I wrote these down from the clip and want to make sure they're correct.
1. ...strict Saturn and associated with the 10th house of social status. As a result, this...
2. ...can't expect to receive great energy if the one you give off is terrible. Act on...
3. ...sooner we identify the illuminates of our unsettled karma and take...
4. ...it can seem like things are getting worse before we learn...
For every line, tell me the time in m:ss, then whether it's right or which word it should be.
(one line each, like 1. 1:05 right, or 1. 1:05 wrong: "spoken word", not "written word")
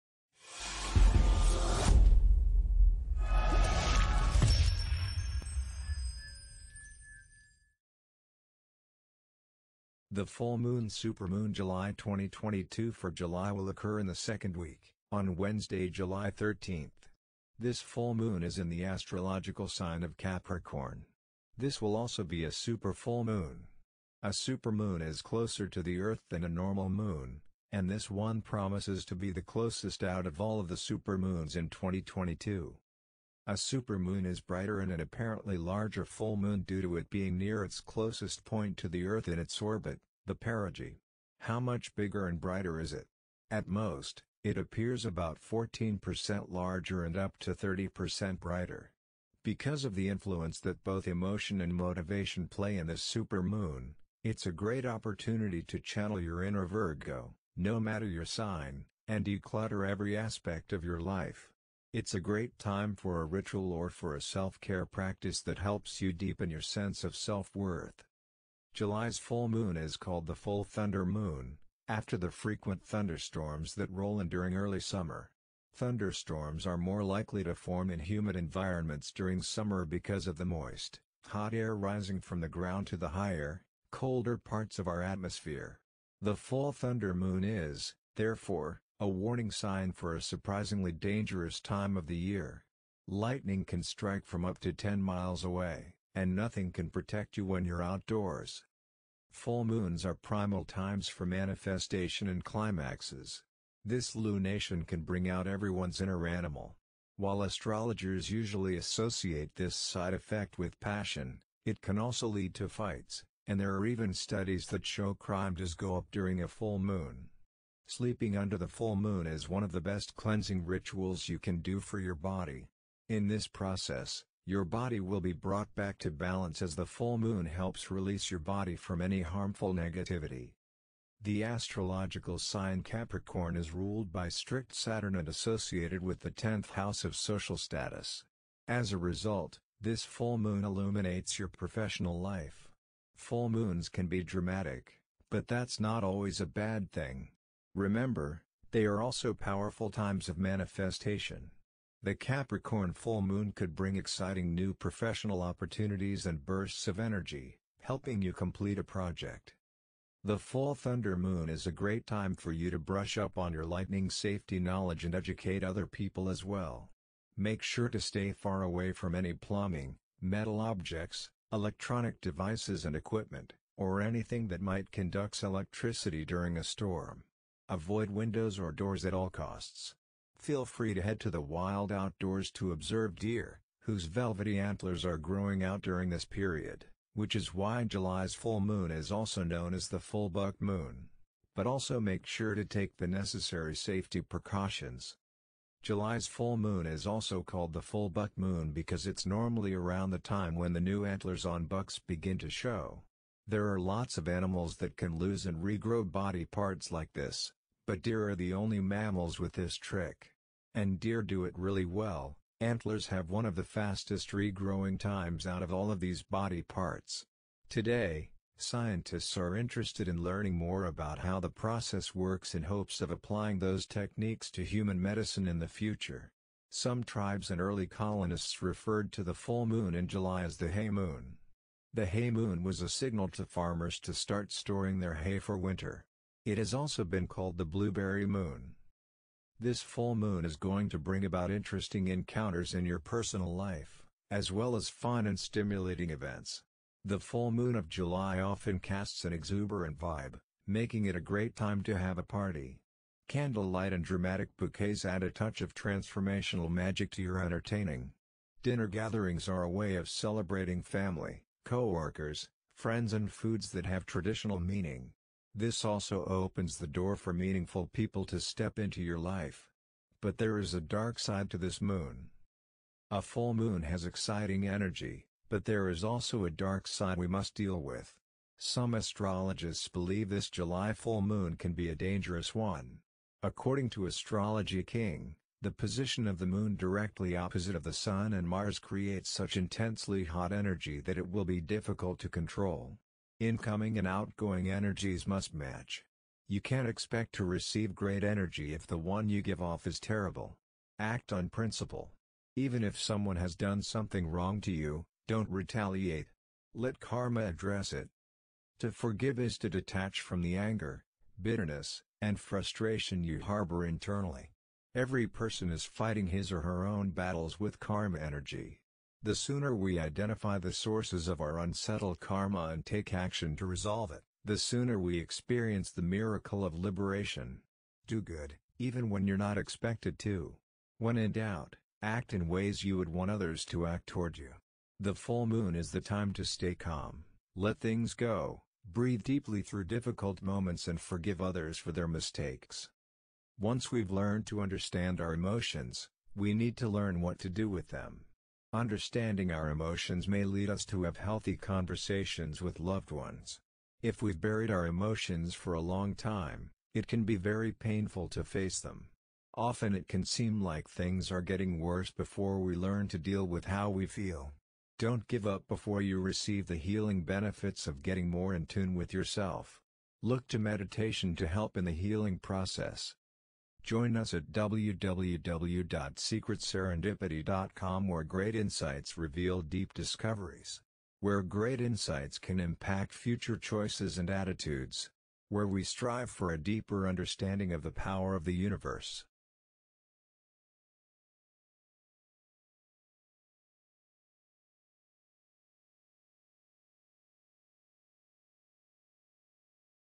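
1. 2:14 right
2. 4:56 right
3. 5:19 wrong: "sources", not "illuminates"
4. 5:59 right.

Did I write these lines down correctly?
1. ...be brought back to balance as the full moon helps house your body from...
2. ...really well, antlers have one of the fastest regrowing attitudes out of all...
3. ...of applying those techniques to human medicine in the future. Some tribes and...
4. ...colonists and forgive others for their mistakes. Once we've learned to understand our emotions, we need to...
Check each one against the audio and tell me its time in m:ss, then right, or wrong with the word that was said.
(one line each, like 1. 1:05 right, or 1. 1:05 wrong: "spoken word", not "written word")
1. 2:05 wrong: "release", not "house"
2. 3:31 wrong: "times", not "attitudes"
3. 3:43 right
4. 5:40 wrong: "moments", not "colonists".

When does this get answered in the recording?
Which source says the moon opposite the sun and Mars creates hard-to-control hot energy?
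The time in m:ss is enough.
4:44.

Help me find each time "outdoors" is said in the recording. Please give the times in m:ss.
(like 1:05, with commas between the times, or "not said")
1:37, 3:01.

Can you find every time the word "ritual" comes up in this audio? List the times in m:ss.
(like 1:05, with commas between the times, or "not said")
1:03, 2:00.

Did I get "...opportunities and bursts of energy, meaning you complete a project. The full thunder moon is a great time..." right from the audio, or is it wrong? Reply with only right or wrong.
wrong.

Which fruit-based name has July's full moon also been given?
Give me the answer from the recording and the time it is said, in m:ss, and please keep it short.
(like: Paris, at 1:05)
Blueberry moon, at 3:57.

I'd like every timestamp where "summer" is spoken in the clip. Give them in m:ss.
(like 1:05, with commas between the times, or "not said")
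1:14, 1:19.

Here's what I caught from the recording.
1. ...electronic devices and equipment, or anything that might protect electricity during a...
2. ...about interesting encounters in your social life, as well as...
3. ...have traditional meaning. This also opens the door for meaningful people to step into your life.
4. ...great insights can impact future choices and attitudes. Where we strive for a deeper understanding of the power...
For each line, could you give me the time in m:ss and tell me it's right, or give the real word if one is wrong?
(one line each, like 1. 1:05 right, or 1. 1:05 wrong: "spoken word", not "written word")
1. 2:51 wrong: "conduct", not "protect"
2. 4:01 wrong: "personal", not "social"
3. 4:23 right
4. 6:21 right.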